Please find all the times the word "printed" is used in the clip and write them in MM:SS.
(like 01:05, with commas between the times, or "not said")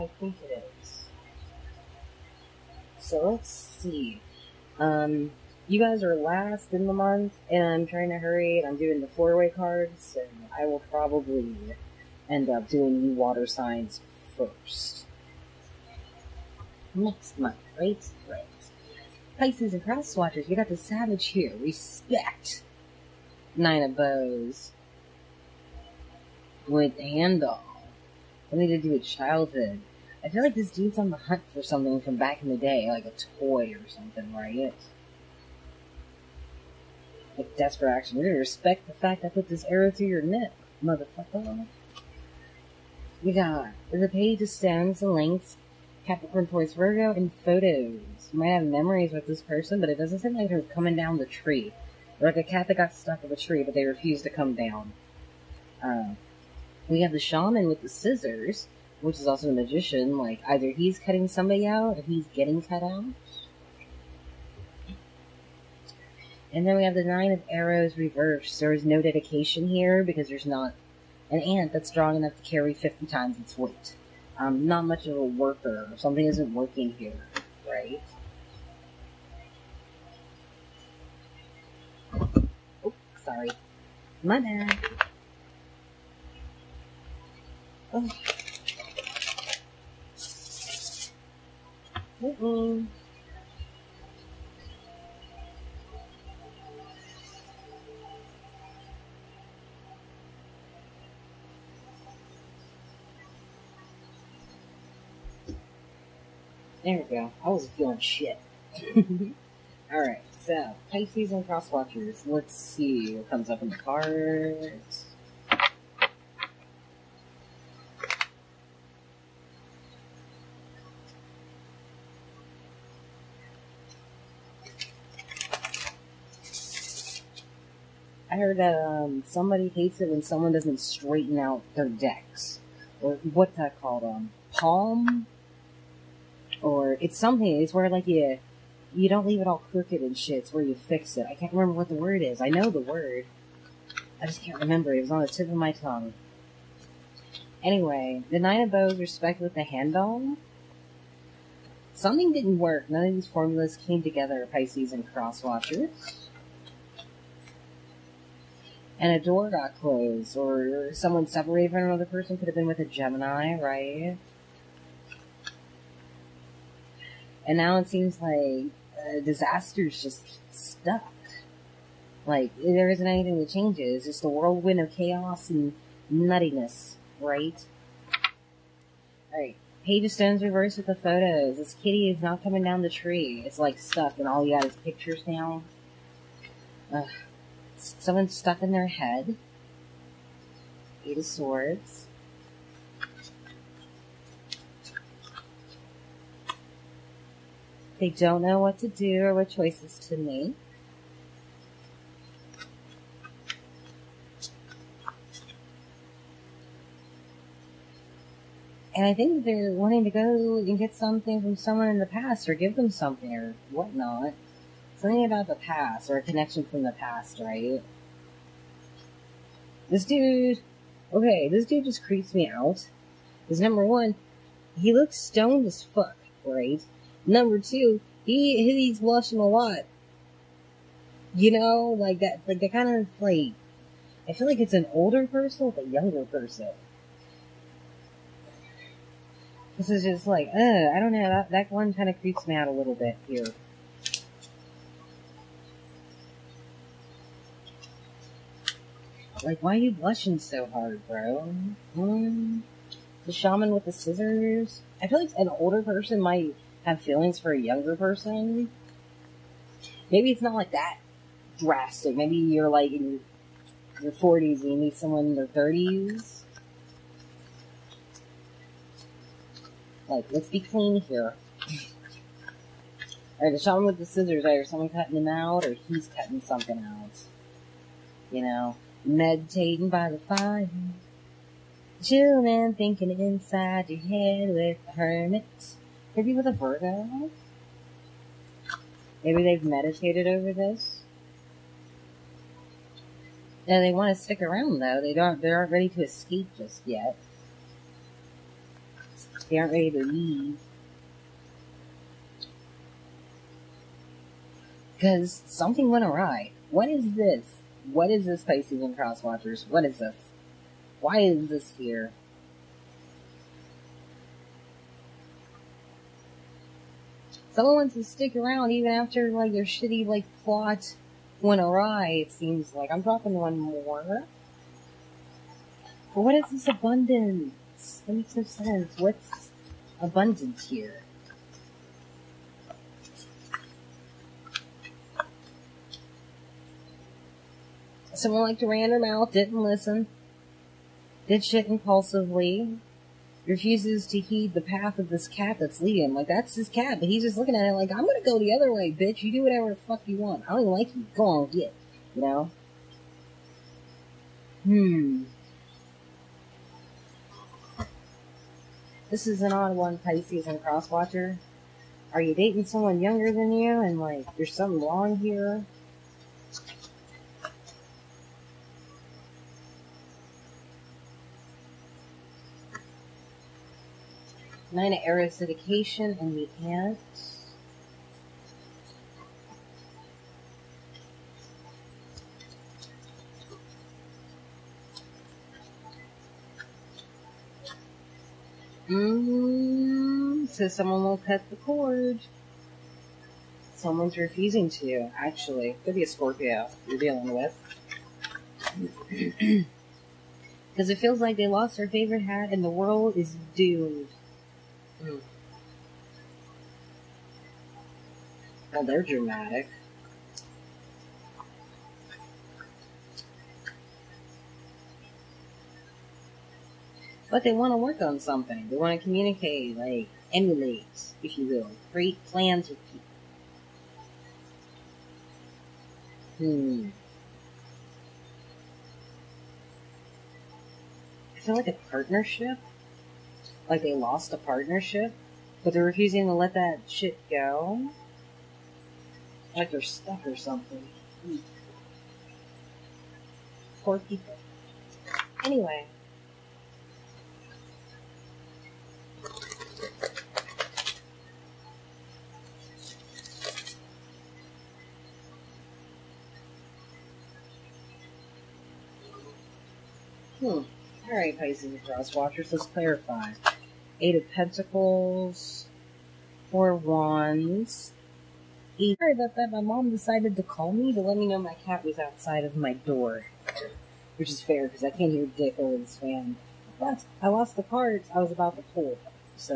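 not said.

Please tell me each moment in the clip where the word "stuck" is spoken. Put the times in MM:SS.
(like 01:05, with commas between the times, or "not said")
00:52, 02:50, 03:03, 03:08, 07:19.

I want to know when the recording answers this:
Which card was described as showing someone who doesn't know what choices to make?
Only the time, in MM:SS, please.
03:11.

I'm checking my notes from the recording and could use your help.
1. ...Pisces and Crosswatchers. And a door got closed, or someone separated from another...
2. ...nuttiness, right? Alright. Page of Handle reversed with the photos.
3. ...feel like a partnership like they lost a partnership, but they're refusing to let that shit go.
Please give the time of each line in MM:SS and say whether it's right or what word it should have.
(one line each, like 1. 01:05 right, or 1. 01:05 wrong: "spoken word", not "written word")
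1. 02:34 right
2. 02:56 wrong: "Stones", not "Handle"
3. 07:11 right.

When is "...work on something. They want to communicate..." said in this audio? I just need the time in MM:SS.
06:57.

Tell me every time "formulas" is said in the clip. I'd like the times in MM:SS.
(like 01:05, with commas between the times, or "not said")
02:33.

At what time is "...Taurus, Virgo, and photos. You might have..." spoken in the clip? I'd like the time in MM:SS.
00:46.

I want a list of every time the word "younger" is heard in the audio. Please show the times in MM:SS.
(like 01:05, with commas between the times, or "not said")
03:55, 04:17, 06:02.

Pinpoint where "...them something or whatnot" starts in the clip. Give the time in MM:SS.
03:32.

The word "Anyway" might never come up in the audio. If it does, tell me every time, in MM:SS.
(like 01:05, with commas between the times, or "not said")
02:27, 07:25.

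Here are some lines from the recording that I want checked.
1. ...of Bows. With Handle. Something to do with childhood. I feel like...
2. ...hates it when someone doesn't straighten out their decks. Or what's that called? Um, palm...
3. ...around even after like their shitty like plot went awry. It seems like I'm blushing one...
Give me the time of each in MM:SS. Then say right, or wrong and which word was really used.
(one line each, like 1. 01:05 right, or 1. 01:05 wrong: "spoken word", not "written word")
1. 00:23 right
2. 02:09 right
3. 05:18 wrong: "dropping", not "blushing".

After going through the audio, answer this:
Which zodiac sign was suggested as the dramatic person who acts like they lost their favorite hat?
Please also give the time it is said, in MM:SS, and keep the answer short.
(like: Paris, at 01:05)
Scorpio, at 06:36.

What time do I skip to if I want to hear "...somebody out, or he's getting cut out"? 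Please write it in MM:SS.
01:01.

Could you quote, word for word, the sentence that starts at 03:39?
This dude, okay, this dude just creeps me out.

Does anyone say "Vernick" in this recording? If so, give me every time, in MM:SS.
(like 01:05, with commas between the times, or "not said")
not said.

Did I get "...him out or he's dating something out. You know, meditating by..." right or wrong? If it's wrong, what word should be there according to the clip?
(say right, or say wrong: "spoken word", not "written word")
wrong: "cutting", not "dating".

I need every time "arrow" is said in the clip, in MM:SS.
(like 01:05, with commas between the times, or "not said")
00:39, 01:07, 06:15.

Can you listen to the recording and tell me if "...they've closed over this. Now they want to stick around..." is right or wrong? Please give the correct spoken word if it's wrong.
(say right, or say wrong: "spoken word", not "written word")
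wrong: "meditated", not "closed".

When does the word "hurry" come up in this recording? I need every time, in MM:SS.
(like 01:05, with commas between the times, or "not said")
00:08.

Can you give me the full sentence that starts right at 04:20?
Maybe it's not like that drastic.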